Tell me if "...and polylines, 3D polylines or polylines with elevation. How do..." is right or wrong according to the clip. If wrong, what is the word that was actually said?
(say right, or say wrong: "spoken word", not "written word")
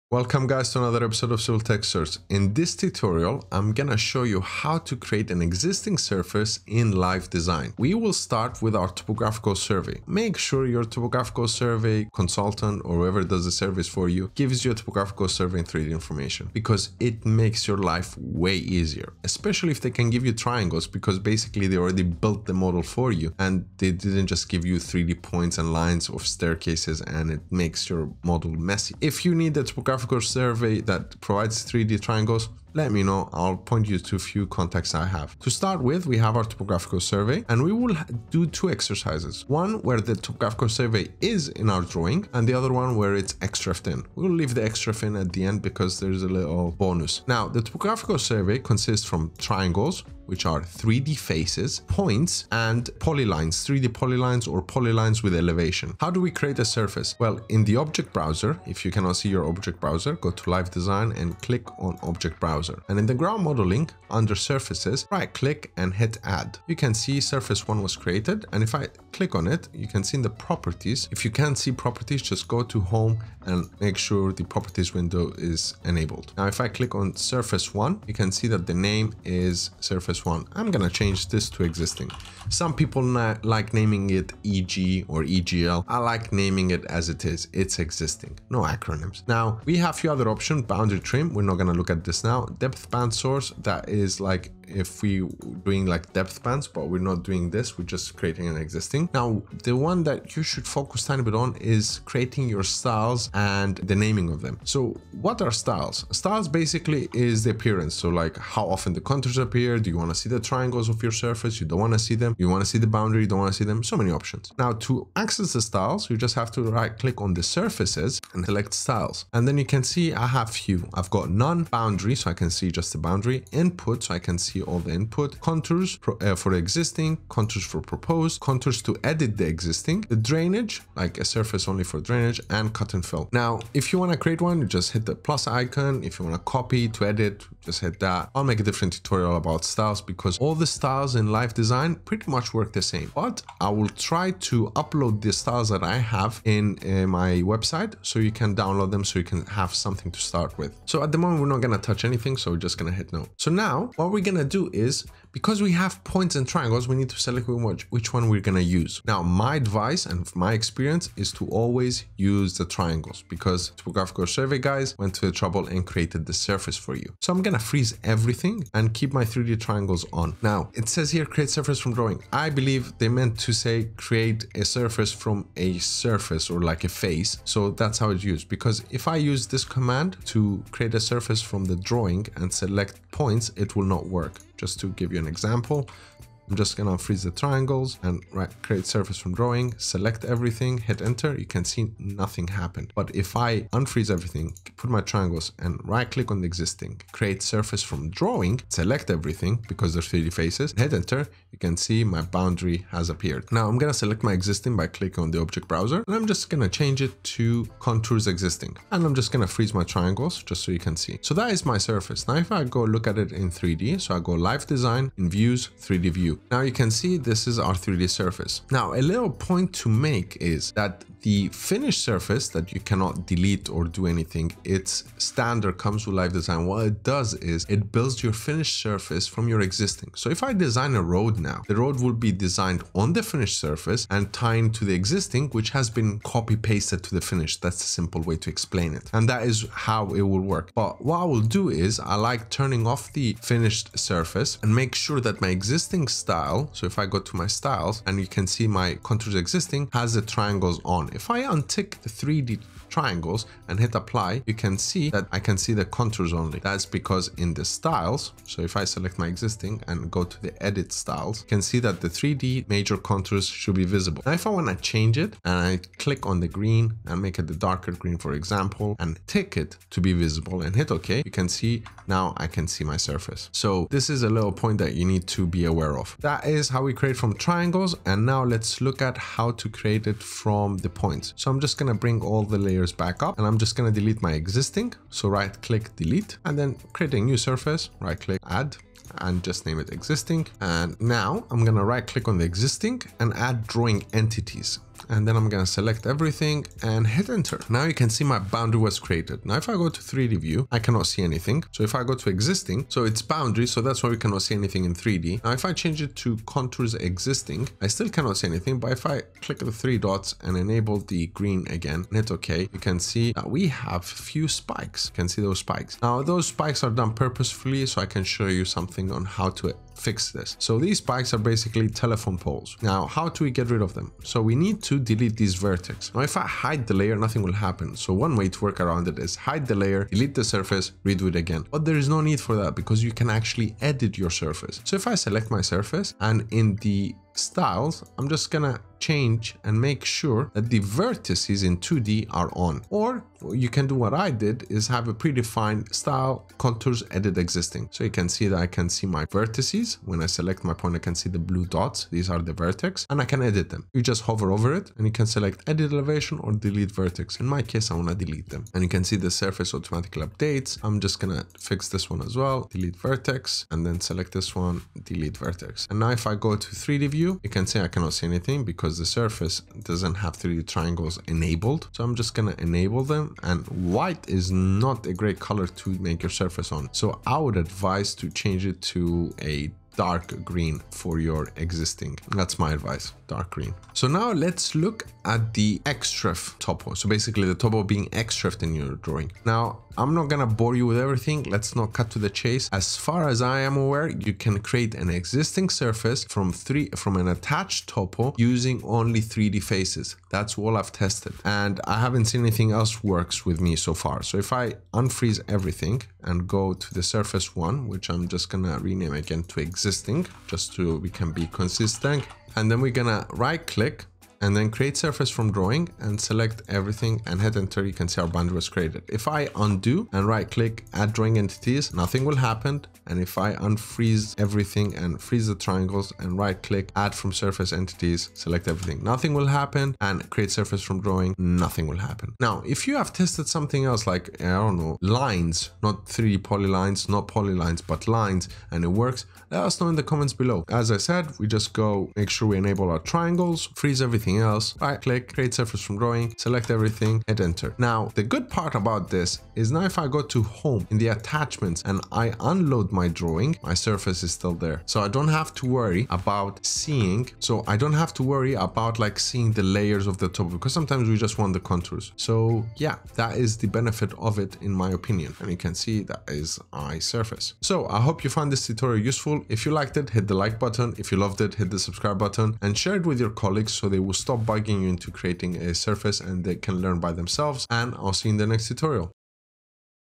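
right.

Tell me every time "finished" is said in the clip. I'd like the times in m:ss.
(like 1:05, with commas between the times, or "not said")
3:41, 3:48, 3:53, 3:57, 4:03.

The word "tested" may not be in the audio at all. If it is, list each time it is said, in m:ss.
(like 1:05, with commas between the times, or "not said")
6:40, 7:13.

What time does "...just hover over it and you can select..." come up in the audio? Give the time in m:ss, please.
5:54.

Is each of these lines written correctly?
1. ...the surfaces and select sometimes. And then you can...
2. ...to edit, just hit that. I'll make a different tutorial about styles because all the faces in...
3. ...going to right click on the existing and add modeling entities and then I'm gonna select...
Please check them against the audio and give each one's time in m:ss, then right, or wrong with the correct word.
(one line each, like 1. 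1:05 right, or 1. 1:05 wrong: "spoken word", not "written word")
1. 1:57 wrong: "styles", not "sometimes"
2. 2:16 wrong: "styles", not "faces"
3. 4:51 wrong: "drawing", not "modeling".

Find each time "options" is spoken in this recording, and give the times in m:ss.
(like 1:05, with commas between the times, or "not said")
1:30, 1:54.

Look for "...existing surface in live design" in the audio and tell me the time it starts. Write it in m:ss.
0:05.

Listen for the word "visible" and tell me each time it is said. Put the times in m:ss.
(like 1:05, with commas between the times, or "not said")
4:23, 4:30.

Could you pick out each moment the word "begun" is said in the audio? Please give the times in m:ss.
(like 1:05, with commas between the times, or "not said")
not said.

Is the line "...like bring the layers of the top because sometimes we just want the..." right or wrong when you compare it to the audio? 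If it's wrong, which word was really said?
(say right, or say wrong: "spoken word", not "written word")
wrong: "seeing", not "bring".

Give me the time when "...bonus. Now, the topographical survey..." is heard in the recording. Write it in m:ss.
0:46.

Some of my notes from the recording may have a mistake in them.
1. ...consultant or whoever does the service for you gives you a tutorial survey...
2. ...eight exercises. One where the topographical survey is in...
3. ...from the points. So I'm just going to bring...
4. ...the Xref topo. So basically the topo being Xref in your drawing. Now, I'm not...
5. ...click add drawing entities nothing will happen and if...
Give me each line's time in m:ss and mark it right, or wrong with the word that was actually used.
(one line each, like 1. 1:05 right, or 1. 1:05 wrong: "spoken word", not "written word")
1. 0:12 wrong: "topographical", not "tutorial"
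2. 0:38 wrong: "two", not "eight"
3. 4:40 right
4. 6:25 right
5. 7:00 right.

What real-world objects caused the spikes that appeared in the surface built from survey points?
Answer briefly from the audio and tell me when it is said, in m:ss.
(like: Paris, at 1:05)
telephone poles, at 5:20.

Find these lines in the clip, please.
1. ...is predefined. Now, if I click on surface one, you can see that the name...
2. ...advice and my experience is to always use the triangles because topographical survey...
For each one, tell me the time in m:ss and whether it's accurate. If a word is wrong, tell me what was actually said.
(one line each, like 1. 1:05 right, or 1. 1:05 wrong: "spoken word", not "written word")
1. 1:15 wrong: "enabled", not "predefined"
2. 2:39 right.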